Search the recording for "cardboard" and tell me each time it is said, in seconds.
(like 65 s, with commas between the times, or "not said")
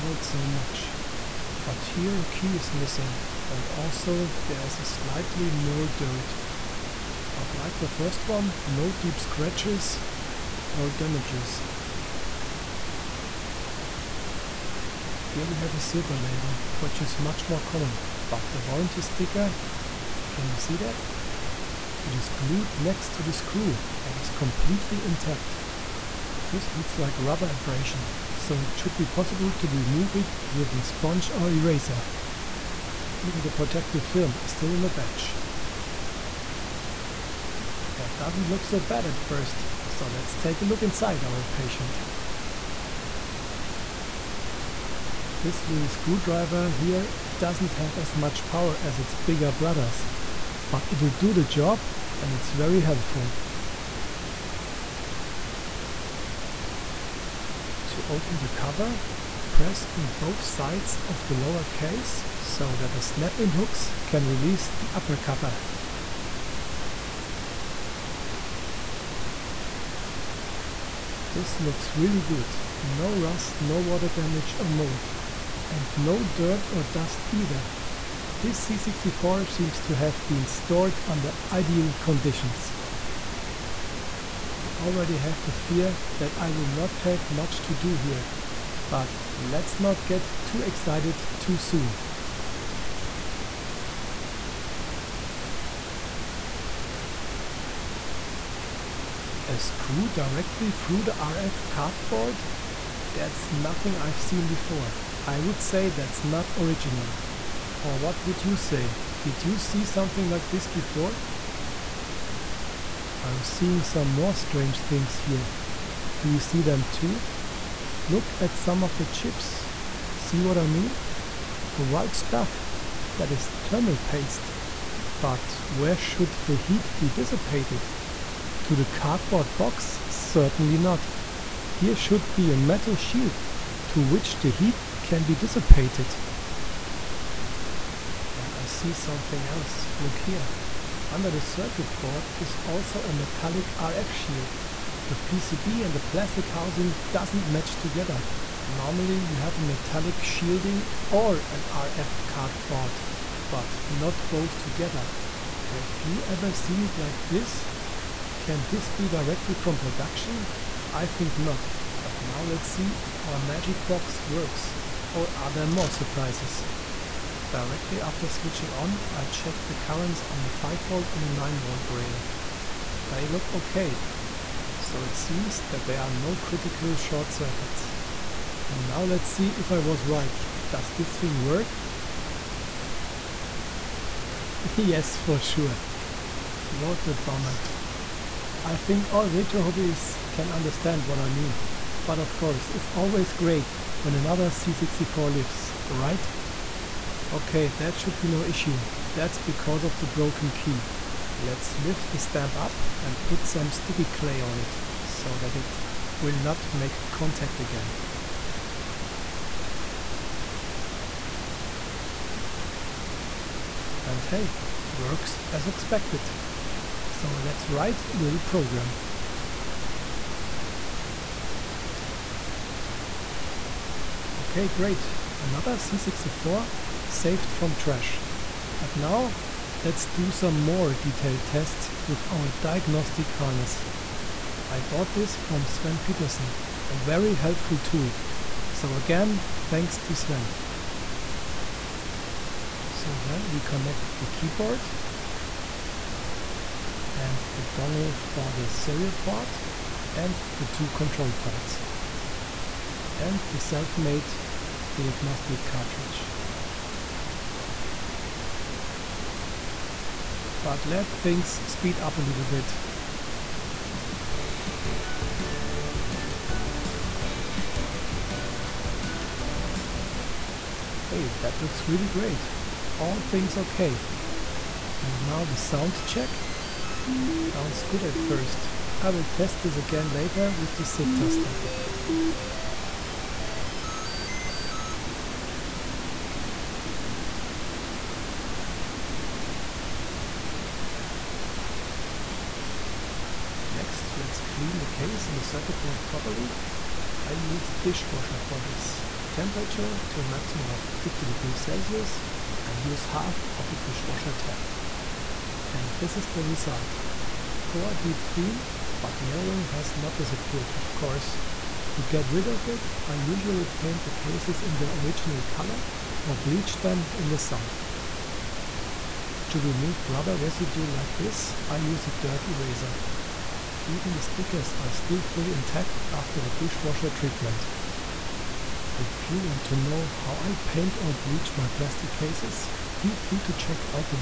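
101 s, 128 s, 152 s.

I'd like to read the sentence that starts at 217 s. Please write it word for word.
So let's write a little program.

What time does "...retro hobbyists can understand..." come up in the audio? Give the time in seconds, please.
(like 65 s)
189 s.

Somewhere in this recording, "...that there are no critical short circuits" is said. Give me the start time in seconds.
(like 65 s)
175 s.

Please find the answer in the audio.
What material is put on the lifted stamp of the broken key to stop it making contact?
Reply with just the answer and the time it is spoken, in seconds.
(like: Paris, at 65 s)
Sticky clay, at 203 s.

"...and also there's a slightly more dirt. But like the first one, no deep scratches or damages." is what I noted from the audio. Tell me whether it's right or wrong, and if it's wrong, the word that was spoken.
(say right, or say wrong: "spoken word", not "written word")
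right.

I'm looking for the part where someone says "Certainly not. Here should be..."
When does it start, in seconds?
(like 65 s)
130 s.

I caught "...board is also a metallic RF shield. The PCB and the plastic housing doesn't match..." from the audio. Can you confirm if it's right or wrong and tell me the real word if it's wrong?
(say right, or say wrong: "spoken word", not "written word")
right.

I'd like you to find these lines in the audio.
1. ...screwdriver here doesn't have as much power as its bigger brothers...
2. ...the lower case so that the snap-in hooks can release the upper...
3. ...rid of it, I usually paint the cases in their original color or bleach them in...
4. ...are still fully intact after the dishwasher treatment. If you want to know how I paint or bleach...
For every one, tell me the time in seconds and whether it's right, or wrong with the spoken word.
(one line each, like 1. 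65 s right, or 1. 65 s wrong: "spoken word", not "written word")
1. 45 s right
2. 61 s right
3. 312 s right
4. 324 s right.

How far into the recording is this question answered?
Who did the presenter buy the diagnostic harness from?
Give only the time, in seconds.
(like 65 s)
235 s.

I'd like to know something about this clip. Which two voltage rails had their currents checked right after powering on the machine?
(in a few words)
5V and 9V.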